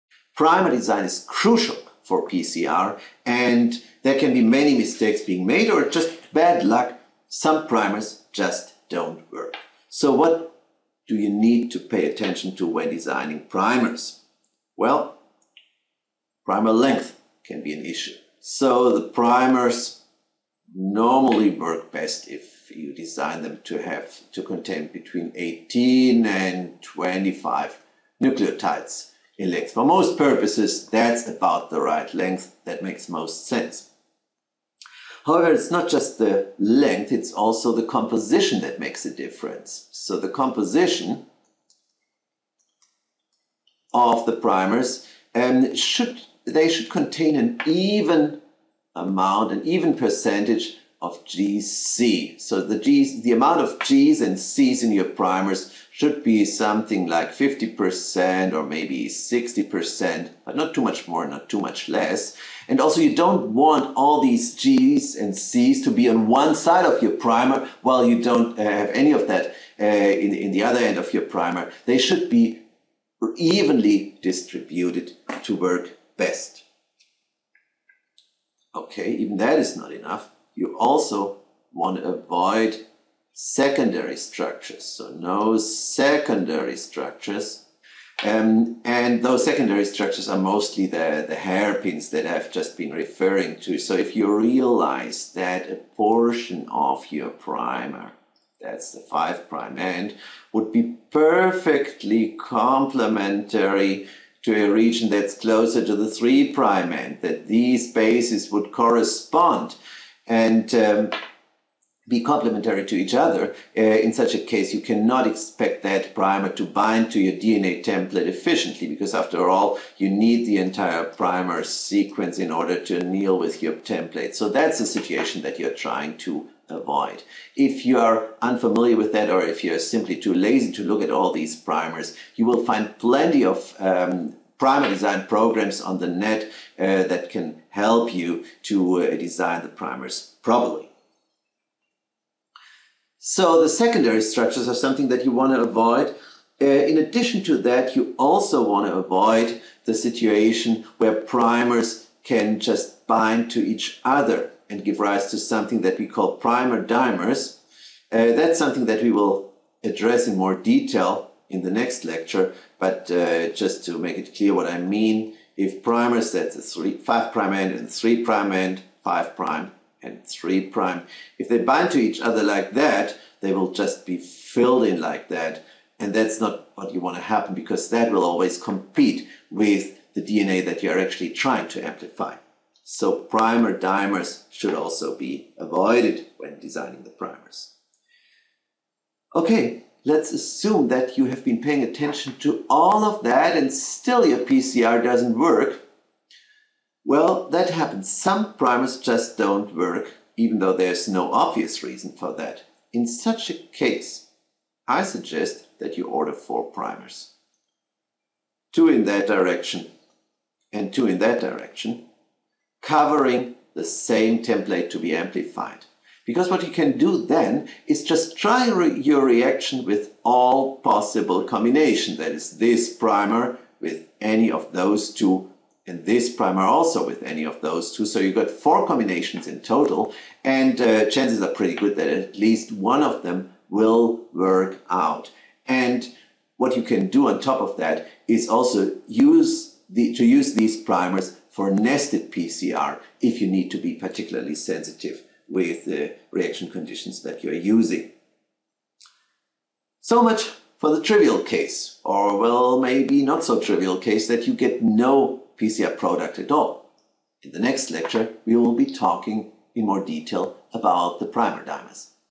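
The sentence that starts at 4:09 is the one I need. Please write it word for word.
So much for the trivial case, or well, maybe not so trivial case that you get no PCR product at all.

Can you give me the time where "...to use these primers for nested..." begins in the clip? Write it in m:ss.
4:00.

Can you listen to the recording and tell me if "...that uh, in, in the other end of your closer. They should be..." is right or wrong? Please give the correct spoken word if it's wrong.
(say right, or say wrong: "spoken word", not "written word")
wrong: "primer", not "closer".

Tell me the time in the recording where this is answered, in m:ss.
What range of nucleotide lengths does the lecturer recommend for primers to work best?
0:24.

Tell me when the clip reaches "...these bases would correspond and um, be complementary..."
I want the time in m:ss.
1:47.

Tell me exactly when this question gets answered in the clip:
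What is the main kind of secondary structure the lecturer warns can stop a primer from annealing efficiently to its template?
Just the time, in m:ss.
1:31.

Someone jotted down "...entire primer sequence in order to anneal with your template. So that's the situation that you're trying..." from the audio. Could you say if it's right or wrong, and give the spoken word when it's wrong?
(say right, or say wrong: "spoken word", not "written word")
right.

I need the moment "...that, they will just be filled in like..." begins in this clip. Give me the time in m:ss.
2:52.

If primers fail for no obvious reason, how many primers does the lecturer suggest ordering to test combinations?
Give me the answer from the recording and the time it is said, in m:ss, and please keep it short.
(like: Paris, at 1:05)
4, at 3:26.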